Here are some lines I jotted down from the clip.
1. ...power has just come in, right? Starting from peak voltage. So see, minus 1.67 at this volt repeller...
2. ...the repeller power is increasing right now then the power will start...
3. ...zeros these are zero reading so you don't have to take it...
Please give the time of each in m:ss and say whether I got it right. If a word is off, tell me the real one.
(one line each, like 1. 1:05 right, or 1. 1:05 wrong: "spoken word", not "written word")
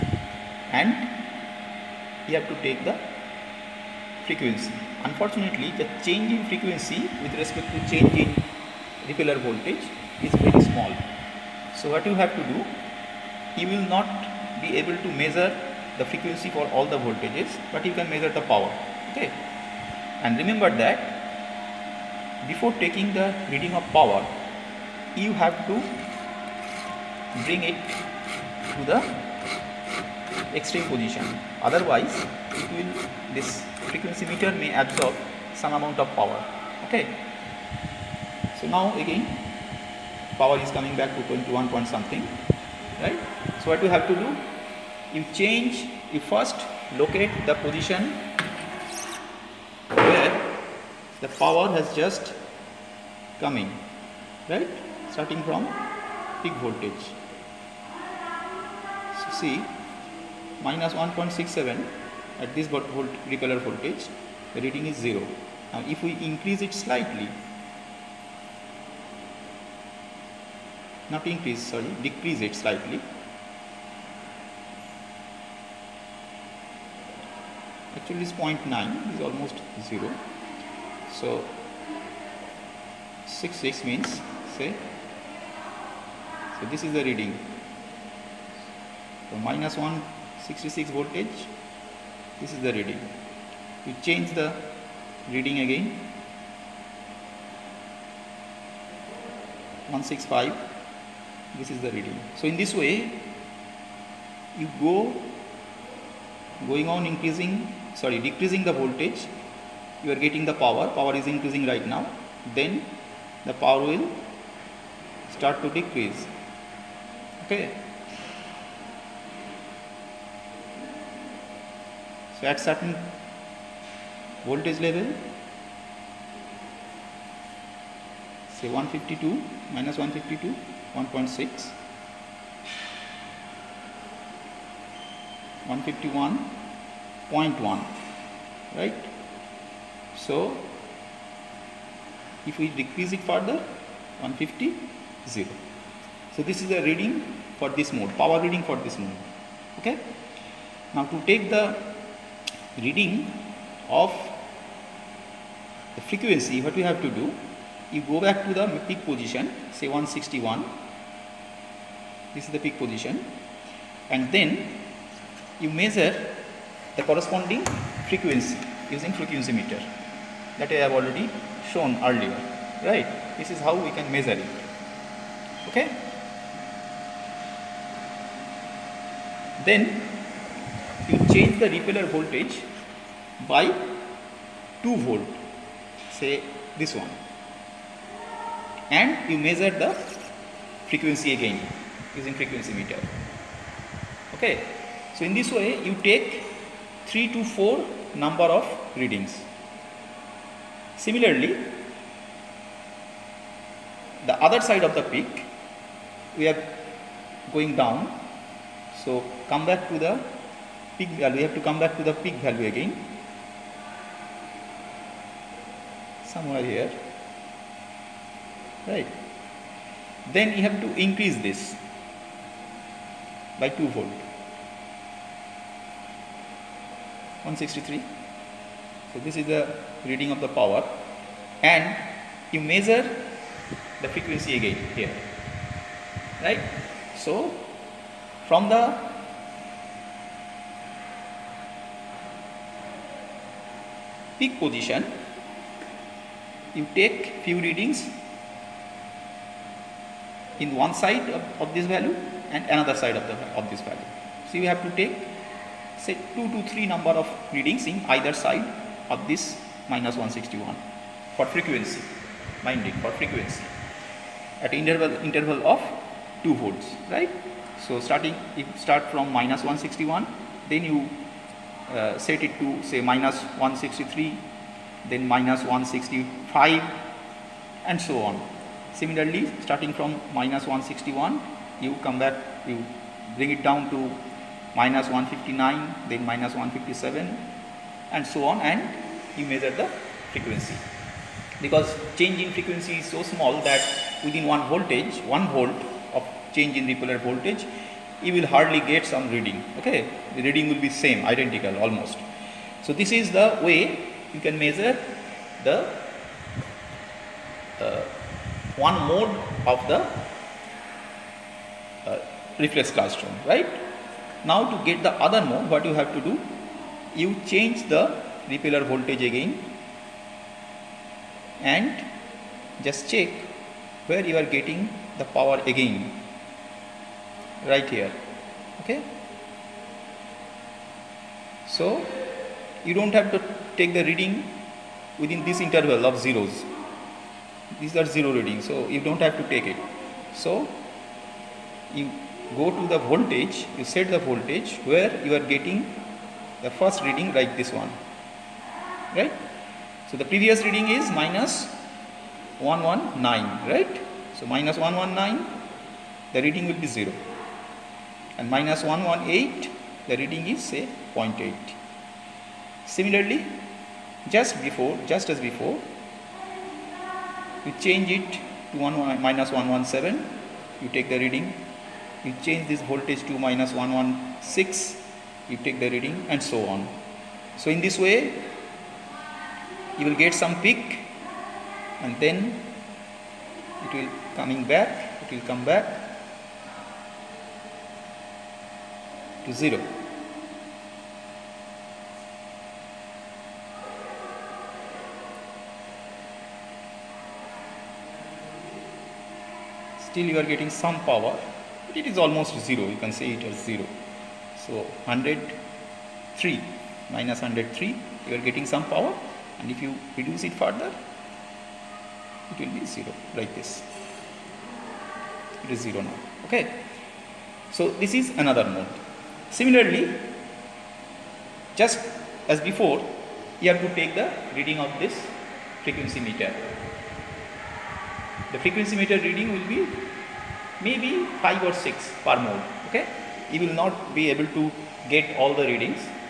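1. 0:51 right
2. 1:50 wrong: "power", not "repeller"
3. 5:36 right.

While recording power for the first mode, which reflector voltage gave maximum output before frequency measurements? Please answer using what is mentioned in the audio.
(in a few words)
-161.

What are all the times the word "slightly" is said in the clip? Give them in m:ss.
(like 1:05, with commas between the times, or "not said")
1:06, 1:12.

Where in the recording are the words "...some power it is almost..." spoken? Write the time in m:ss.
6:40.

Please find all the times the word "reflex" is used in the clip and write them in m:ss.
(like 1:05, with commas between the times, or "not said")
5:12.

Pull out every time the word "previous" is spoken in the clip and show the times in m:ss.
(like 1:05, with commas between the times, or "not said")
5:50.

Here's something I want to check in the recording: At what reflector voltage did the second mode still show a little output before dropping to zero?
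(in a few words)
-103.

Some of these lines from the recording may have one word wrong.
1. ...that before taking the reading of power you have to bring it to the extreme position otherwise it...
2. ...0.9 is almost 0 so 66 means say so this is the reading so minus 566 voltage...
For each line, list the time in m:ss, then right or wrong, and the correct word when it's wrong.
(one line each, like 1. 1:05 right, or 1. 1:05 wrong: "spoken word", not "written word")
1. 0:20 right
2. 1:18 wrong: "166", not "566".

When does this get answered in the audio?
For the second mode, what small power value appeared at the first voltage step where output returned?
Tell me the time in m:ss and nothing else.
6:01.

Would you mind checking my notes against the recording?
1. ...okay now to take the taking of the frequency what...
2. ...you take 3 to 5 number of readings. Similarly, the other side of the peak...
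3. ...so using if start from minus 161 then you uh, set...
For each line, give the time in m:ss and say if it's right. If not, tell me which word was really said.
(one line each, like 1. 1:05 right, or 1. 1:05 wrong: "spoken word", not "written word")
1. 2:29 wrong: "reading", not "taking"
2. 3:15 wrong: "4", not "5"
3. 4:27 wrong: "starting", not "using".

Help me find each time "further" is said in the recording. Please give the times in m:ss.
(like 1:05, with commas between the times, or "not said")
2:23, 6:50.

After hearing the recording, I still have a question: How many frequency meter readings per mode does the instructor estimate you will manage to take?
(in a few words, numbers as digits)
5 or 6.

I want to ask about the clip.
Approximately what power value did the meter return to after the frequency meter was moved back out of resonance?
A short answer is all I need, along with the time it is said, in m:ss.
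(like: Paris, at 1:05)
21, at 0:41.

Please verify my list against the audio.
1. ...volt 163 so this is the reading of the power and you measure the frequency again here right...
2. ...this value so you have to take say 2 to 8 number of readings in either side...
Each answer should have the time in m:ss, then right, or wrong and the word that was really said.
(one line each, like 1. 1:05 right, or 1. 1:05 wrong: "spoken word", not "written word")
1. 3:43 right
2. 4:13 wrong: "3", not "8".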